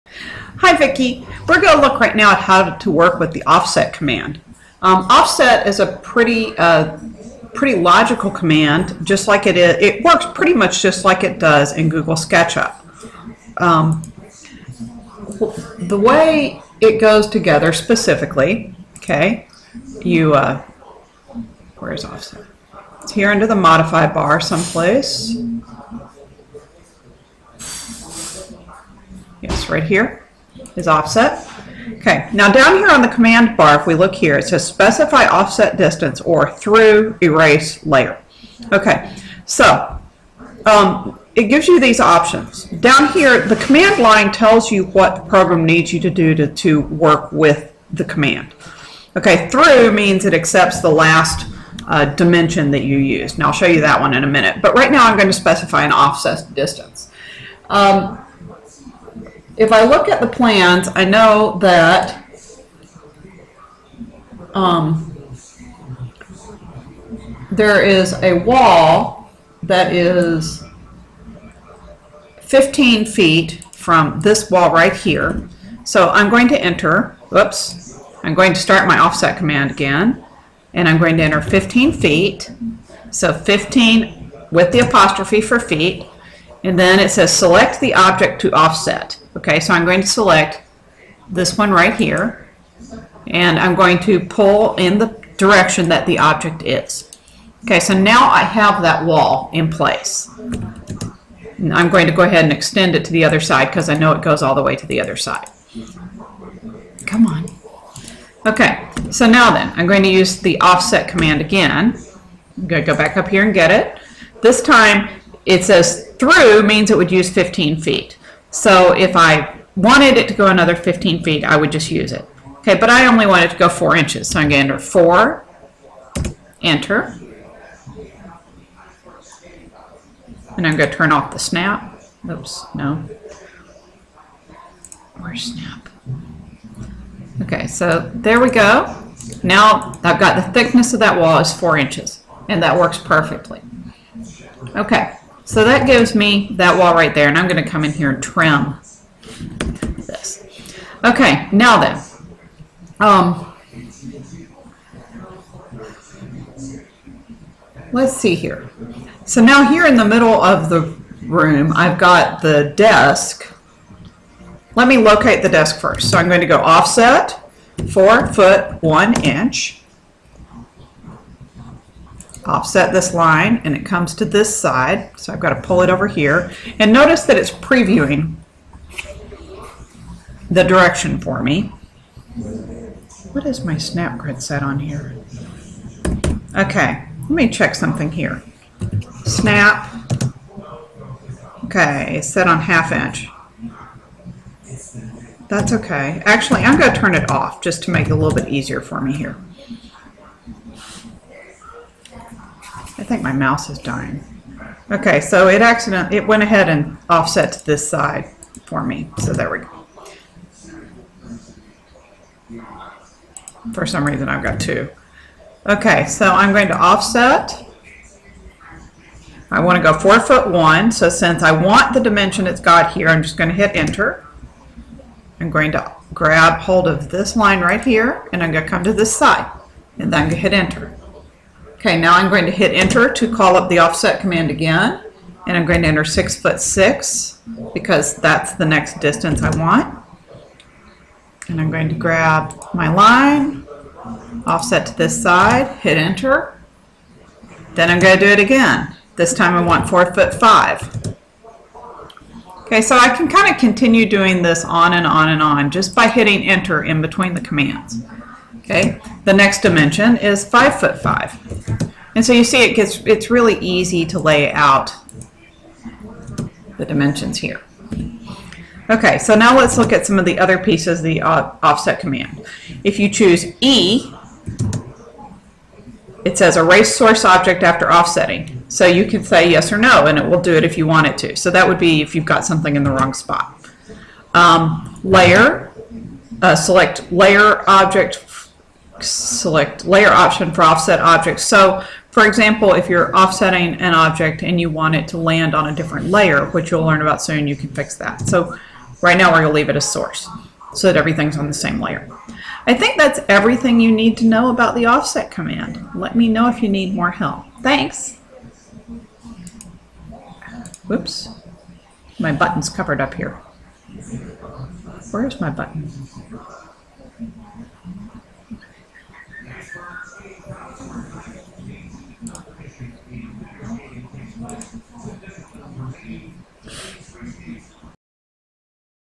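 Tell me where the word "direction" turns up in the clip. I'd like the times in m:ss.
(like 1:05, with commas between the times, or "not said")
1:35, 3:00.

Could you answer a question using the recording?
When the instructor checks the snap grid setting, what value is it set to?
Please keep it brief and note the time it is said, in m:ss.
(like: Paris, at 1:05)
half inch, at 3:12.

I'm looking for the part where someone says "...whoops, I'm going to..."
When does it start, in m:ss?
1:17.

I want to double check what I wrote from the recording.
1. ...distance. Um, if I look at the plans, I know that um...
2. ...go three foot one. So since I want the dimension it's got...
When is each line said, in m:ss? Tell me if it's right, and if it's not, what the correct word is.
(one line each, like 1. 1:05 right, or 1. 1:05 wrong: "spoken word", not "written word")
1. 0:56 right
2. 3:39 wrong: "four", not "three".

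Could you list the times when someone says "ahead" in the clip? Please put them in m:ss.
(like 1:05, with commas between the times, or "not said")
1:42, 3:26.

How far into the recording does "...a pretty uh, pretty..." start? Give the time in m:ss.
0:05.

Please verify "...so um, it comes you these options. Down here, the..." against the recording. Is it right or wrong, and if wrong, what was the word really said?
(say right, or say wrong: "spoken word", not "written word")
wrong: "gives", not "comes".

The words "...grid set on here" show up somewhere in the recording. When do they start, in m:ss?
3:04.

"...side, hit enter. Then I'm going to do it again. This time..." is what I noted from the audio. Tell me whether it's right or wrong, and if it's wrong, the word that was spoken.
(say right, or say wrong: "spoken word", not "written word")
right.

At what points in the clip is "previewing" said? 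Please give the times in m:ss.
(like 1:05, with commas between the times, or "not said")
2:57.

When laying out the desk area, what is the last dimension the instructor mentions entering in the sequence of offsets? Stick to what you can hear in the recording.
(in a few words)
5 foot 5.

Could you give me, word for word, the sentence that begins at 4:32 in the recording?
If you choose E, it says erase source object after offsetting.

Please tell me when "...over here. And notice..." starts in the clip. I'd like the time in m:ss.
2:55.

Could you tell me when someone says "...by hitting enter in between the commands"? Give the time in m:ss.
4:15.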